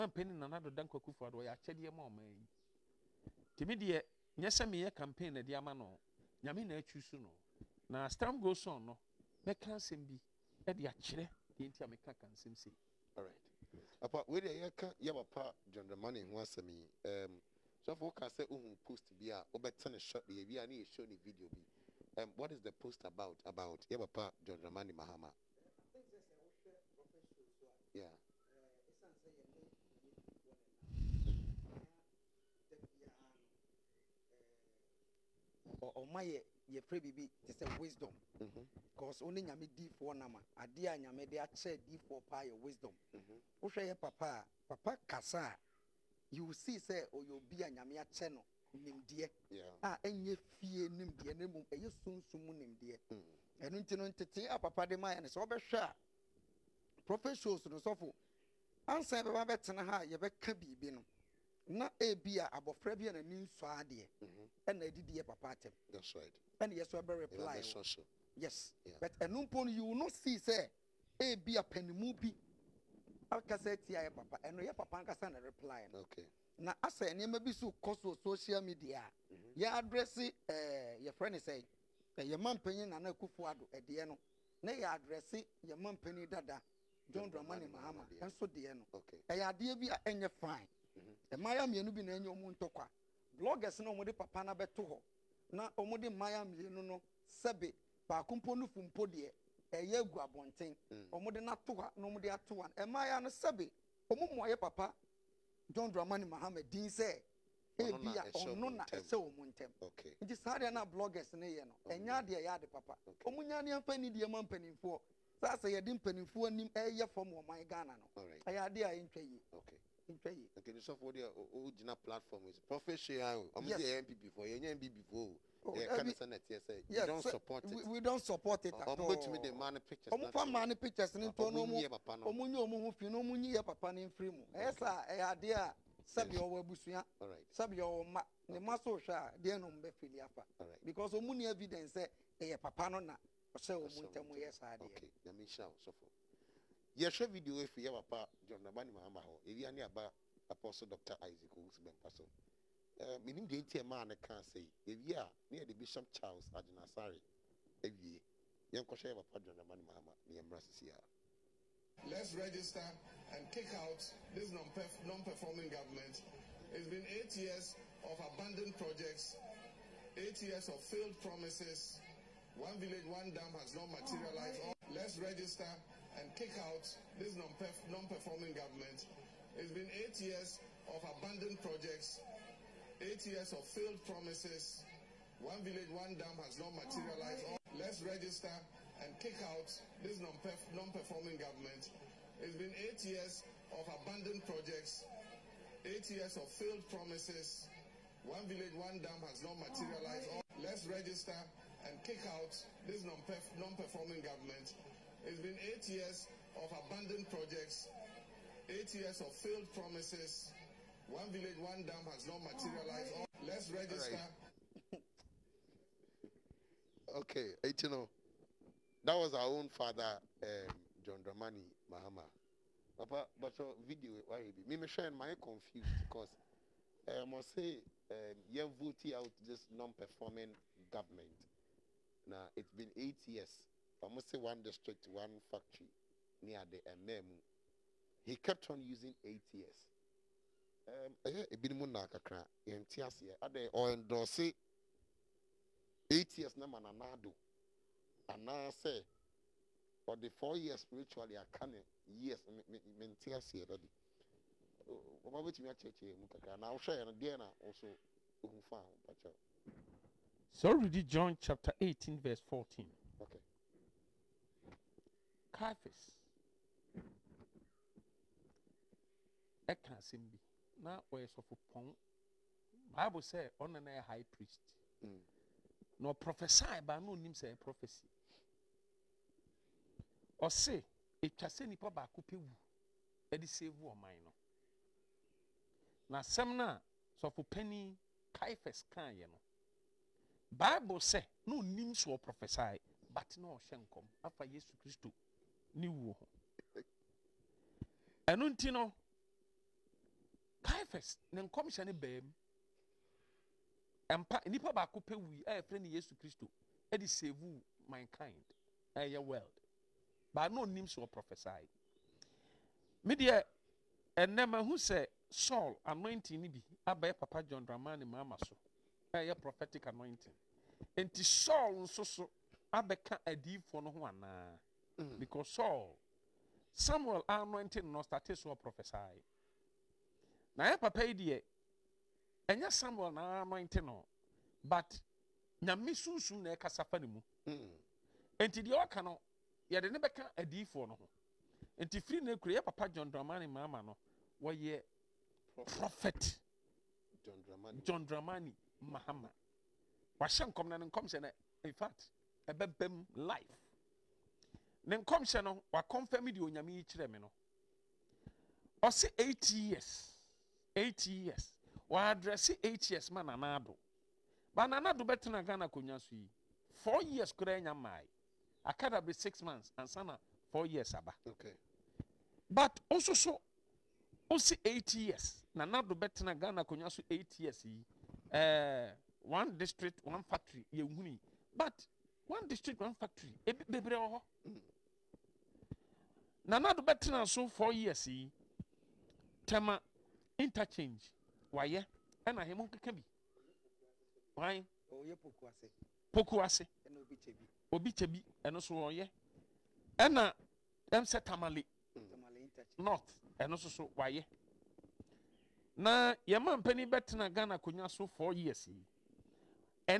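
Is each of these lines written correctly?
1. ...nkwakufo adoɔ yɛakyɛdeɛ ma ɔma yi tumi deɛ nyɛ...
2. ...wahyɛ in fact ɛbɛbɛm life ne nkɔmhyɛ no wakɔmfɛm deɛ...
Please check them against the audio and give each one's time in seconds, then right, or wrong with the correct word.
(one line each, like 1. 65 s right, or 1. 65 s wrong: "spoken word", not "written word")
1. 0 s right
2. 350 s wrong: "nkɔmhyɛ", not "wahyɛ".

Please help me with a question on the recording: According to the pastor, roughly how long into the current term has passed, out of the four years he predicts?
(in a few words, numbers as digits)
6 months.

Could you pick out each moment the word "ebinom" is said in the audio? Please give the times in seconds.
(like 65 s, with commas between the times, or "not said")
241 s.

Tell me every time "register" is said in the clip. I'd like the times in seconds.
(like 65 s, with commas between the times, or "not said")
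162 s, 175 s, 188 s, 200 s, 213 s.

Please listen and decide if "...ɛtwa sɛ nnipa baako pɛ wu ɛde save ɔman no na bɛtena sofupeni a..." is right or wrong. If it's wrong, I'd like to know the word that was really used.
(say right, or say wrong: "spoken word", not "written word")
wrong: "semna", not "bɛtena".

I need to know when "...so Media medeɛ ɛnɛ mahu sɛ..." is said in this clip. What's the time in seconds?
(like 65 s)
310 s.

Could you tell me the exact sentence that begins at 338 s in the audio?
nti deɛ ɔka no yɛde ne bɛka adiifoɔ no ho nti firi ne kura yɛ papa john dramani Mama no wɔyɛ.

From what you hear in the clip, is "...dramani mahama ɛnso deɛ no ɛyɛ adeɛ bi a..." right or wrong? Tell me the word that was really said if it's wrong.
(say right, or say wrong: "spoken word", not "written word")
right.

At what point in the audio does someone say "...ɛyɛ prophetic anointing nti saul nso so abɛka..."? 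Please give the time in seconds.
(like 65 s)
319 s.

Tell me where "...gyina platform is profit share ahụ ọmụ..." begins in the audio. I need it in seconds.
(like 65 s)
121 s.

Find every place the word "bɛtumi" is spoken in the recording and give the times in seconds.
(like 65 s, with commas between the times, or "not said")
129 s, 255 s.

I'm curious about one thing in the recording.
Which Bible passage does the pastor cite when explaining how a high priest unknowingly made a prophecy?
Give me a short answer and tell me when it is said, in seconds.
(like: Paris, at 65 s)
John 18:14, at 260 s.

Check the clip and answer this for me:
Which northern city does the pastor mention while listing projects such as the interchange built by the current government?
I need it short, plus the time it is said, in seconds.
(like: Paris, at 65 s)
Tamale, at 401 s.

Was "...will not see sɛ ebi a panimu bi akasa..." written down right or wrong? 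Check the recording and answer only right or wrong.
right.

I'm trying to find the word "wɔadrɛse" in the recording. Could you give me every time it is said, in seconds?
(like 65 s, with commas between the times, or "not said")
361 s.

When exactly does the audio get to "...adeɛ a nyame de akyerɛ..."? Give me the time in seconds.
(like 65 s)
40 s.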